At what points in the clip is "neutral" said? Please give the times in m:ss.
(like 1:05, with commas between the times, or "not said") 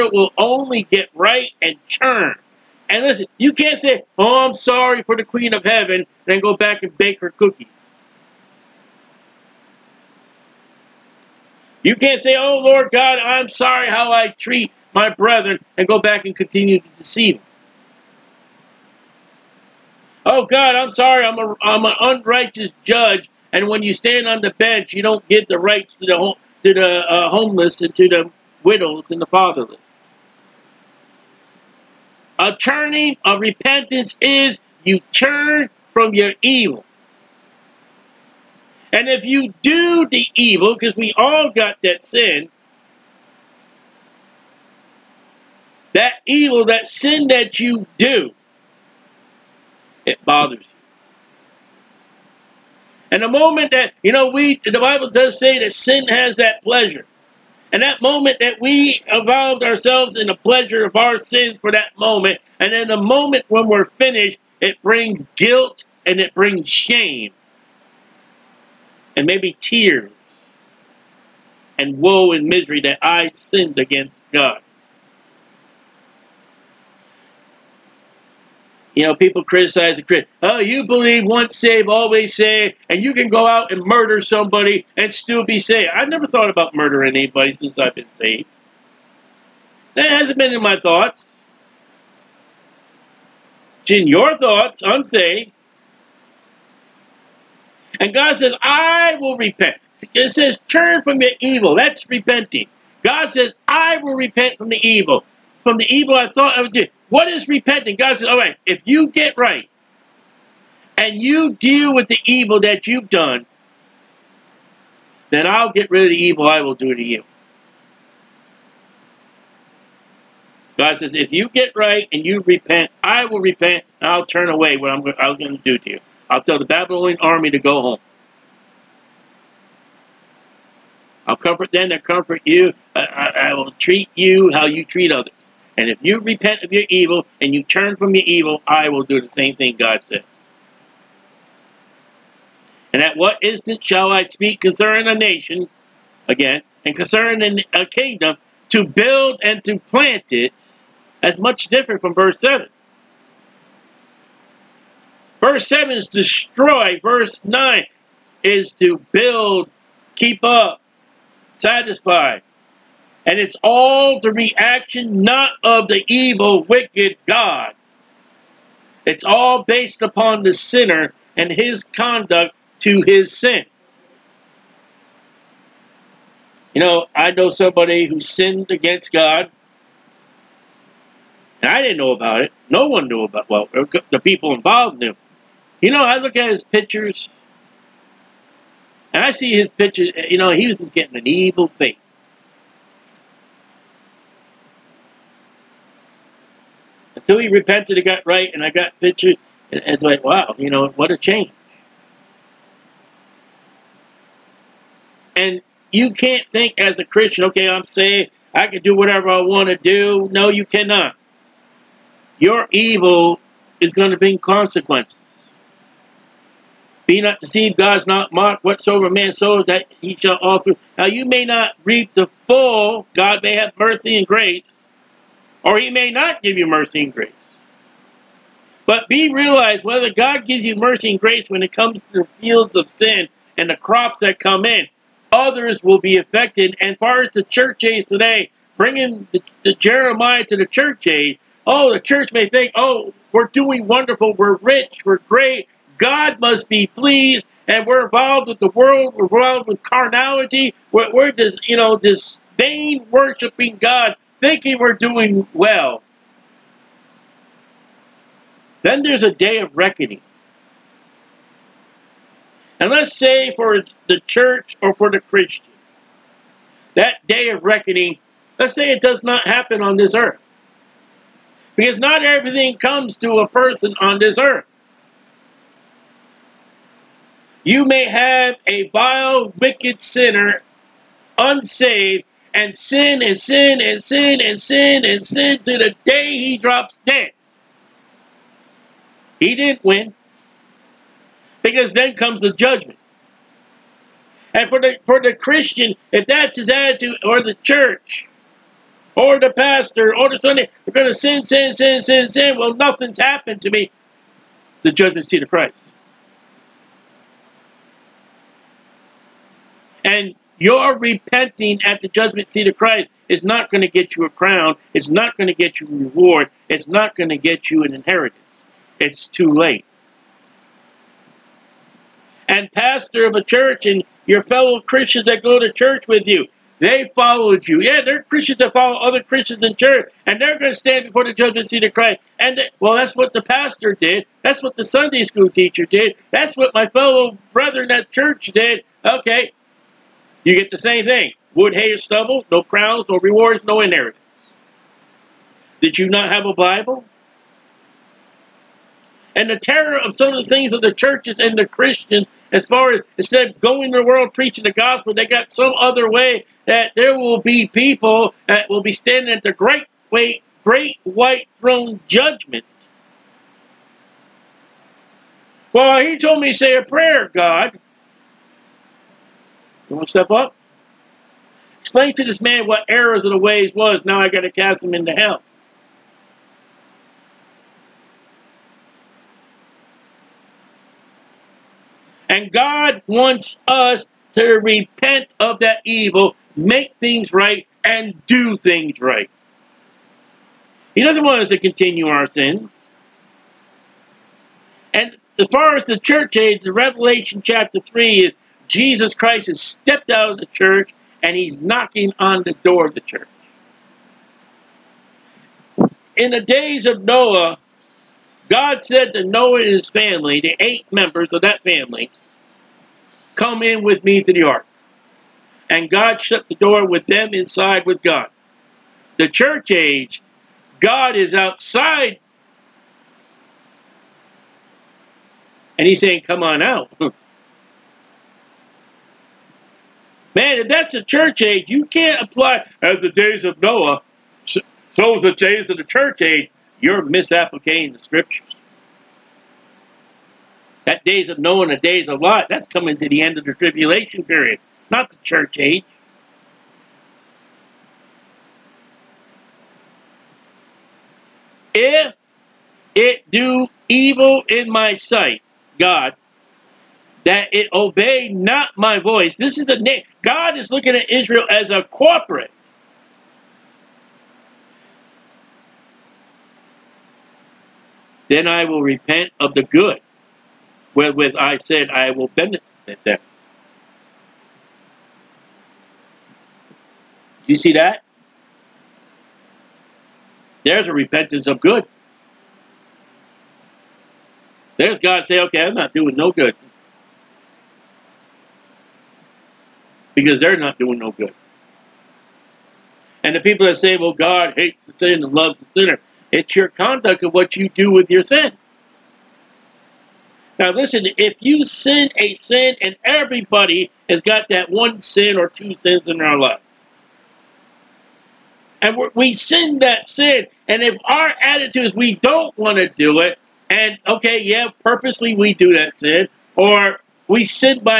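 not said.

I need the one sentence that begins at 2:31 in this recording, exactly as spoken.
As much different from verse 7.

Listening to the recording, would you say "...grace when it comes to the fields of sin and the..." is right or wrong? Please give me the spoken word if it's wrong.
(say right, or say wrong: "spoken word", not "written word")
right.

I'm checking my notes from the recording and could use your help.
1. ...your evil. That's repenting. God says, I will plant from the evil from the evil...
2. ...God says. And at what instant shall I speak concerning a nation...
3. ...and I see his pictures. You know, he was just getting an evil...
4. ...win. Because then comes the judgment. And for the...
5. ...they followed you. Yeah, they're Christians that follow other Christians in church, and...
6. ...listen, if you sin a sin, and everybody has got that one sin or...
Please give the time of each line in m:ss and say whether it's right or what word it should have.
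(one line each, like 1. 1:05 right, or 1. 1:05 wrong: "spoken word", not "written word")
1. 1:41 wrong: "repent", not "plant"
2. 2:19 right
3. 3:09 right
4. 4:49 right
5. 5:26 right
6. 8:20 right.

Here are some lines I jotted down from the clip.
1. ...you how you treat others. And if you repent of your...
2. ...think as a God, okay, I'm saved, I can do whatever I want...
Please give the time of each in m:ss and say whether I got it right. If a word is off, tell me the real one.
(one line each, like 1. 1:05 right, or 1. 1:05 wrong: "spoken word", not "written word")
1. 2:14 right
2. 3:26 wrong: "Christian", not "God".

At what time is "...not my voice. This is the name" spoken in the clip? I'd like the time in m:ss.
7:38.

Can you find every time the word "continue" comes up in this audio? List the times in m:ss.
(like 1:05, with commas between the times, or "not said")
0:16, 6:31.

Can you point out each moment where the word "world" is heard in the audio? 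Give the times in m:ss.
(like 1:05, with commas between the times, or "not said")
4:08, 5:54.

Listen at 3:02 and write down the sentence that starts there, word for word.
No one knew about well, the people involved knew.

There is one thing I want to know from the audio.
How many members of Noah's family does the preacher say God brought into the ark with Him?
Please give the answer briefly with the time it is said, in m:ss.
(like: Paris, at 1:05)
8, at 6:50.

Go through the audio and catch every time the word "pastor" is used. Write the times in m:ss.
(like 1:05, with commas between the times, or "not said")
4:59, 5:22, 5:33.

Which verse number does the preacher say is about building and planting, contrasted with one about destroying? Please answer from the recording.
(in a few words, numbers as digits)
Verse 9.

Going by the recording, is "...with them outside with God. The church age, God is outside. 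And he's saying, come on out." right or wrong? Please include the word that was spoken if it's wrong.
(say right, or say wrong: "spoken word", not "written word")
wrong: "inside", not "outside".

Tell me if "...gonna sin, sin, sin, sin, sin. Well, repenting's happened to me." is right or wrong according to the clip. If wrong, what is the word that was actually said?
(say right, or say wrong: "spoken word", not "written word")
wrong: "nothing", not "repenting".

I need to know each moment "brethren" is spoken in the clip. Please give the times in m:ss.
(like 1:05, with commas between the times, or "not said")
0:15, 5:37.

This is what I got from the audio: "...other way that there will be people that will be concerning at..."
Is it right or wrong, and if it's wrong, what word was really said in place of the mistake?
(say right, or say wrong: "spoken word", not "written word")
wrong: "standing", not "concerning".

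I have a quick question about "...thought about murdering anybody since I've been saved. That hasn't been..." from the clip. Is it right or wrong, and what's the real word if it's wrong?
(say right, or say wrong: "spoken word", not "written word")
right.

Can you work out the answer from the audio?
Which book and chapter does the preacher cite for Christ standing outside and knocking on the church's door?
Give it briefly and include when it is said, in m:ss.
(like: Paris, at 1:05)
Revelation chapter 3, at 6:36.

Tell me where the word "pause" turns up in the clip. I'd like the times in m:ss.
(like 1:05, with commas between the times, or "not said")
not said.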